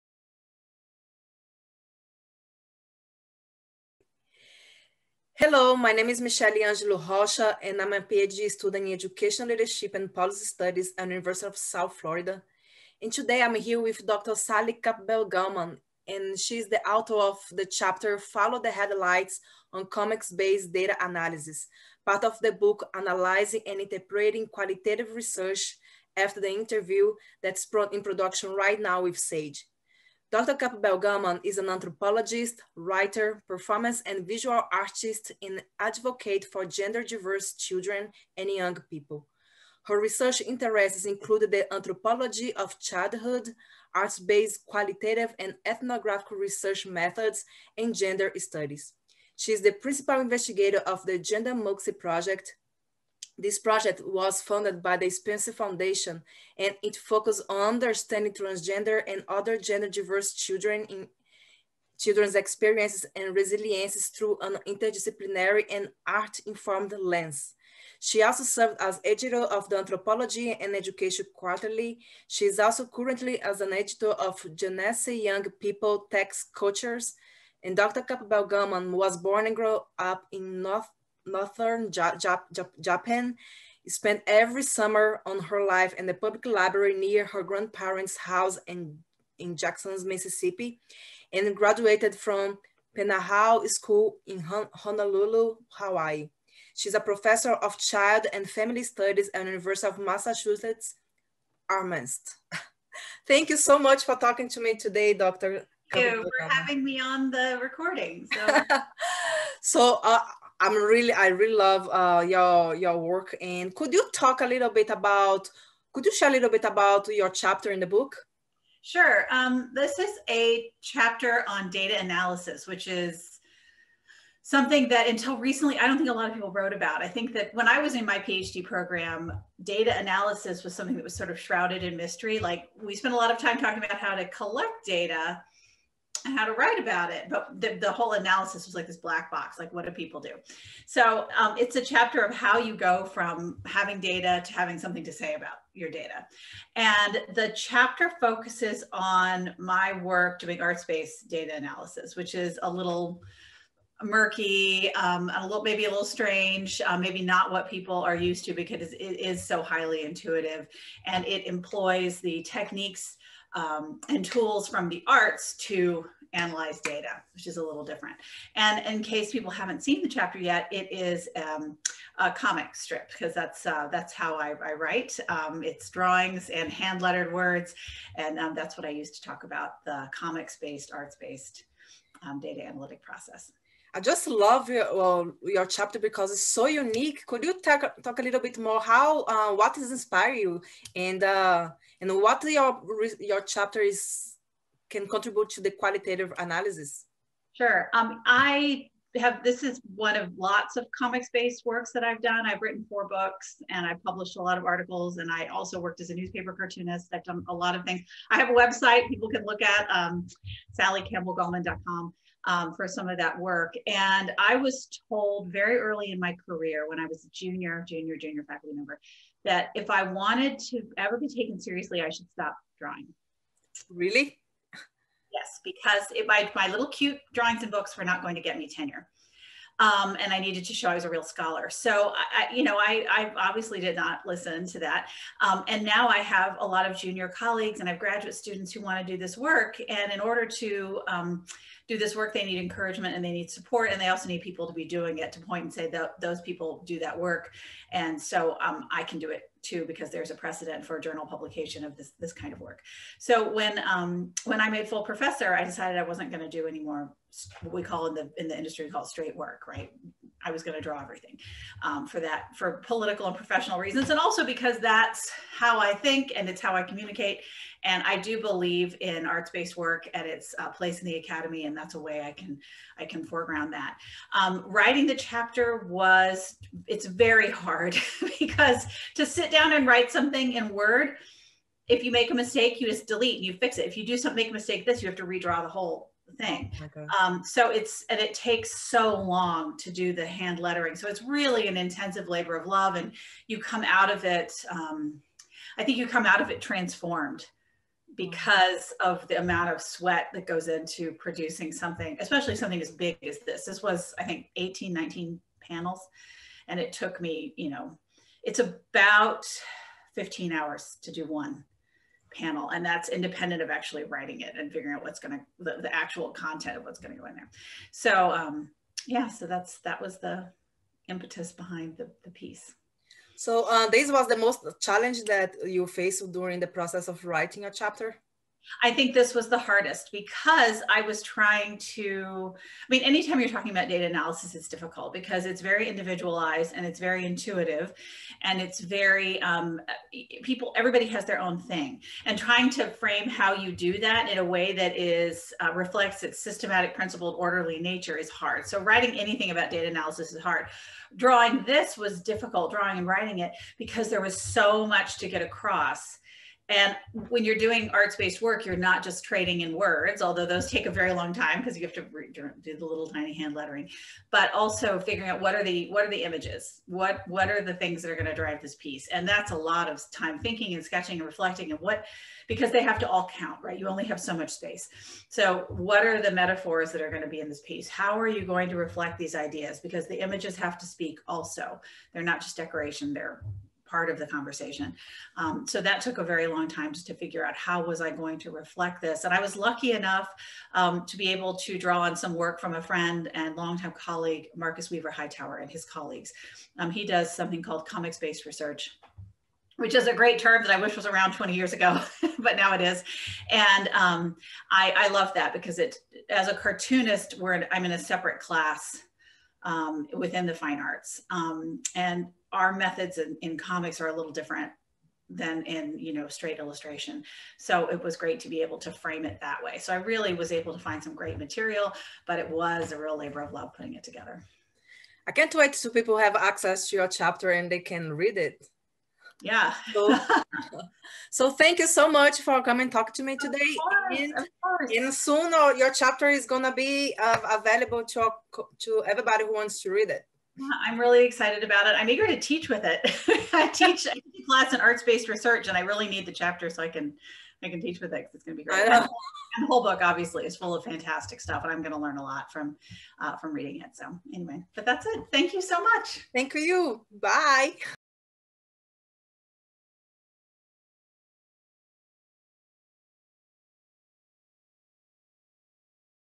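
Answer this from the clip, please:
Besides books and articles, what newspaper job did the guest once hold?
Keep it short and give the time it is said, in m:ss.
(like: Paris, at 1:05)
Newspaper cartoonist, at 3:26.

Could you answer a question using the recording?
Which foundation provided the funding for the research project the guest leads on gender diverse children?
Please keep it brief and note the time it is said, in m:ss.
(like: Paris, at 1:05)
Spencer Foundation, at 0:55.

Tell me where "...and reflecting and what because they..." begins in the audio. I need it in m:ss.
6:11.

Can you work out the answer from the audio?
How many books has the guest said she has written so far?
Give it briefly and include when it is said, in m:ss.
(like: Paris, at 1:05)
4, at 3:22.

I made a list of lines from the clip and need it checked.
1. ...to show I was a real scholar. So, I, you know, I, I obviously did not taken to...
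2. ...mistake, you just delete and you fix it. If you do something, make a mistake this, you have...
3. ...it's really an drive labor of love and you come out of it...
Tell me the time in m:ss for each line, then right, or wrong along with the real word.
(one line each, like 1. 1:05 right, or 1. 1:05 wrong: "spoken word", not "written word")
1. 3:50 wrong: "listen", not "taken"
2. 4:42 right
3. 4:51 wrong: "intensive", not "drive".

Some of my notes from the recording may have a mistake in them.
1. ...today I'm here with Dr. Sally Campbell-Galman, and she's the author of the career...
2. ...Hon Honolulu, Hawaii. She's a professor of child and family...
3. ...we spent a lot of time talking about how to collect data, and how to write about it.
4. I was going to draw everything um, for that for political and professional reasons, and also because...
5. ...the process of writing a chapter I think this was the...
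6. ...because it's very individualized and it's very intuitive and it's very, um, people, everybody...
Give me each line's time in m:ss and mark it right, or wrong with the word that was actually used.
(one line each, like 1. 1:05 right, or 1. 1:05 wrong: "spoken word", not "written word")
1. 0:13 wrong: "chapter", not "career"
2. 1:34 right
3. 2:12 right
4. 4:20 right
5. 5:26 right
6. 5:35 right.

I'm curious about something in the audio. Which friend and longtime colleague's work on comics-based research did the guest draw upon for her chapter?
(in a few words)
Marcus Weaver Hightower.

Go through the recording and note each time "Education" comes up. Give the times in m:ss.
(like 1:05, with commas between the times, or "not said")
0:08, 1:10.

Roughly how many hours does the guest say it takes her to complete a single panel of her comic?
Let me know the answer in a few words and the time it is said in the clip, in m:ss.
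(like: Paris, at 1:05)
15, at 5:10.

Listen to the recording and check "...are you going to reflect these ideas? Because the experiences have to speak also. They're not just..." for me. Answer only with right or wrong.
wrong.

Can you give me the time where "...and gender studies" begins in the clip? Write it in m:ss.
0:47.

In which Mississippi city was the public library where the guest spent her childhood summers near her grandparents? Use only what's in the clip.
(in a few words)
Jackson.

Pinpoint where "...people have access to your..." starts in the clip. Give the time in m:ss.
7:05.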